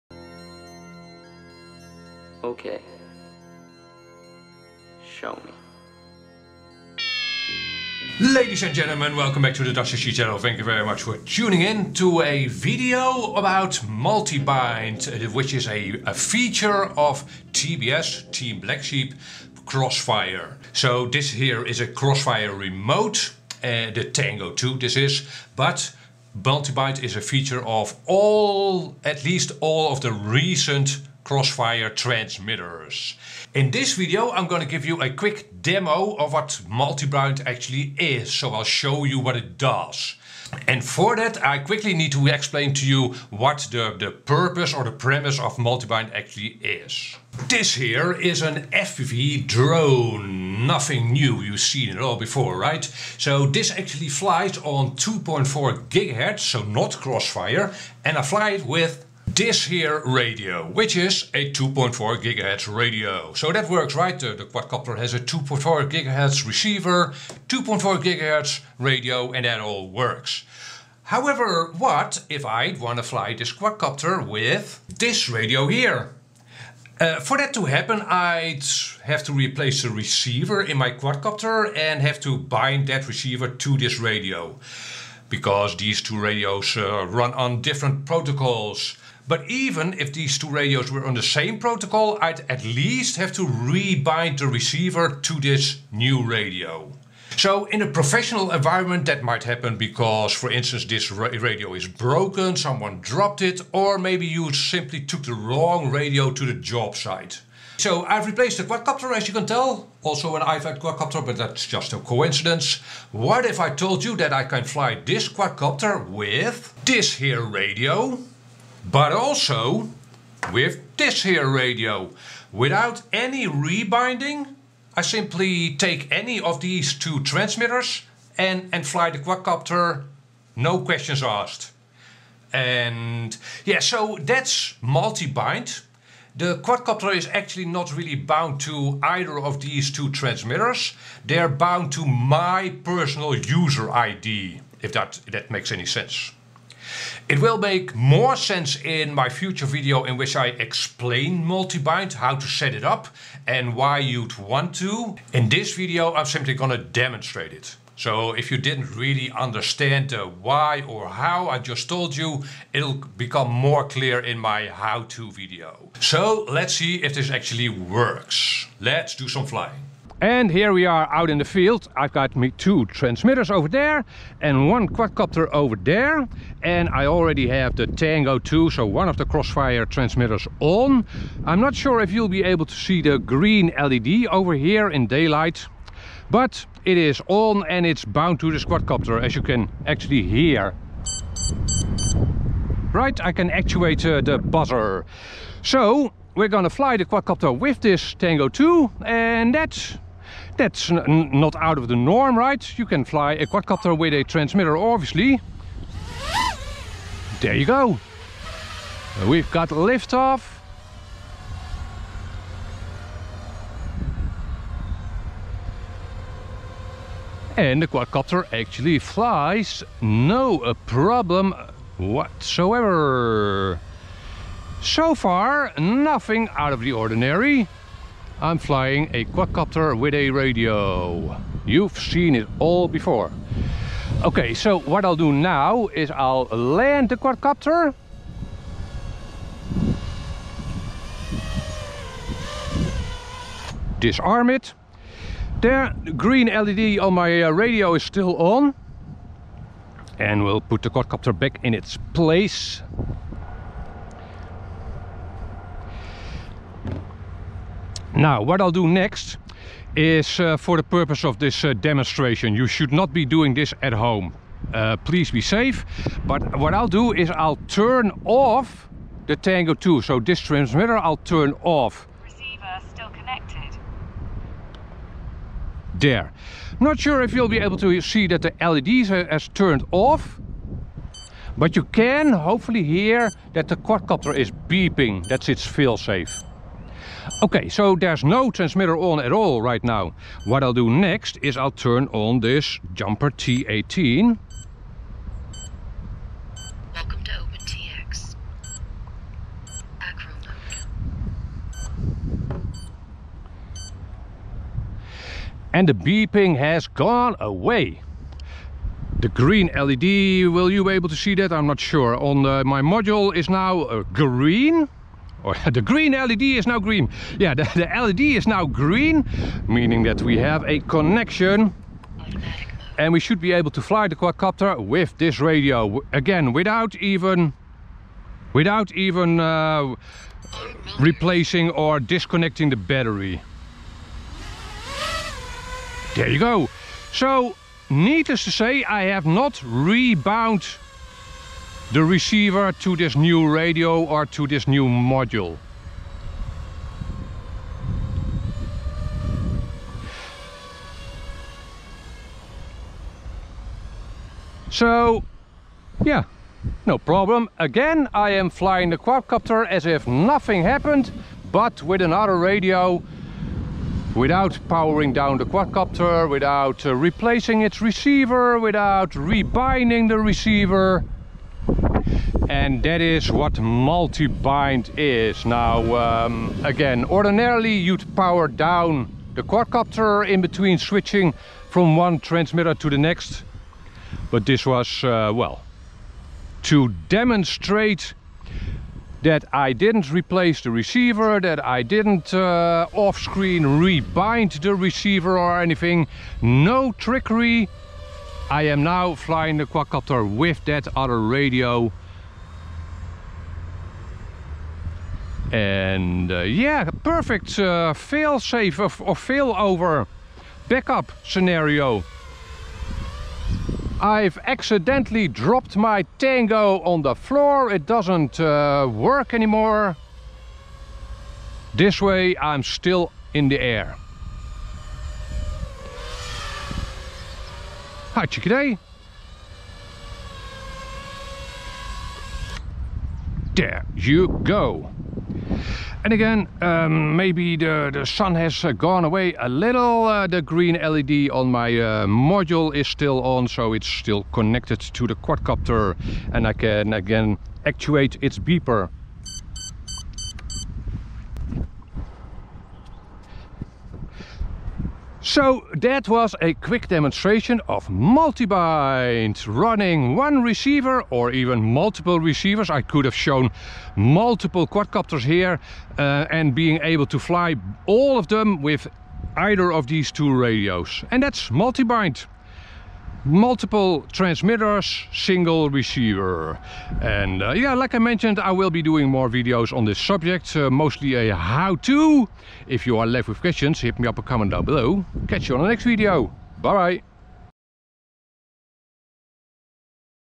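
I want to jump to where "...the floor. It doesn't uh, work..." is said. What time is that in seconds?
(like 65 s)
417 s.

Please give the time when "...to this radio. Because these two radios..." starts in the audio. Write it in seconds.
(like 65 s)
83 s.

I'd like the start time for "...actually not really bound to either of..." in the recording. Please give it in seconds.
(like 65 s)
137 s.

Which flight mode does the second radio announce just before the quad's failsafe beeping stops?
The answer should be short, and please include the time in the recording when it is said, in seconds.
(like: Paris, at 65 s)
Acro mode, at 299 s.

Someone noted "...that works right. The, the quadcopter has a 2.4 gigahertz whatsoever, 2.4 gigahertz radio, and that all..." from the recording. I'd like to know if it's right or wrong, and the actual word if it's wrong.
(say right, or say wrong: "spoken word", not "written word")
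wrong: "receiver", not "whatsoever".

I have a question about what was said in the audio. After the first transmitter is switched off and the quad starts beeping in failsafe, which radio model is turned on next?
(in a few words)
Jumper T18.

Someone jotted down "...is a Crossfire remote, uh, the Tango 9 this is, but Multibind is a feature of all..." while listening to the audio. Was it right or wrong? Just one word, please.
wrong.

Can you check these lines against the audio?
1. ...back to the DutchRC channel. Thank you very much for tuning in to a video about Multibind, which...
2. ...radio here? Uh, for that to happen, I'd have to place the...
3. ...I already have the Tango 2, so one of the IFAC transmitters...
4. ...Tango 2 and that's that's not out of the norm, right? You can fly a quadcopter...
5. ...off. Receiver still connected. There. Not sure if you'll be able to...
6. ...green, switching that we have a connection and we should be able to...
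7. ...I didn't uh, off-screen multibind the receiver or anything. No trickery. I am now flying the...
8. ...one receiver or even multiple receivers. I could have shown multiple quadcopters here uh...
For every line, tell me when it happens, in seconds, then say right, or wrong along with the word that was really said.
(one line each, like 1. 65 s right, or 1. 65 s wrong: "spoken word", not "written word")
1. 9 s right
2. 75 s wrong: "replace", not "place"
3. 176 s wrong: "Crossfire", not "IFAC"
4. 198 s right
5. 271 s right
6. 318 s wrong: "meaning", not "switching"
7. 391 s wrong: "rebind", not "multibind"
8. 460 s right.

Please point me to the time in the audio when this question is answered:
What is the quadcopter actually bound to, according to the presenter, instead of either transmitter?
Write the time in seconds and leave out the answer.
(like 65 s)
142 s.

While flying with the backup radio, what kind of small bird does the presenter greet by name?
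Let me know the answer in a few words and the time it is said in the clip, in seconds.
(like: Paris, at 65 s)
chickadee, at 428 s.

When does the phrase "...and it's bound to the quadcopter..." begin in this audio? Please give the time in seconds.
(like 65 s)
187 s.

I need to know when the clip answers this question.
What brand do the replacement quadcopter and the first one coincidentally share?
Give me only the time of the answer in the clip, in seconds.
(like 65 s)
110 s.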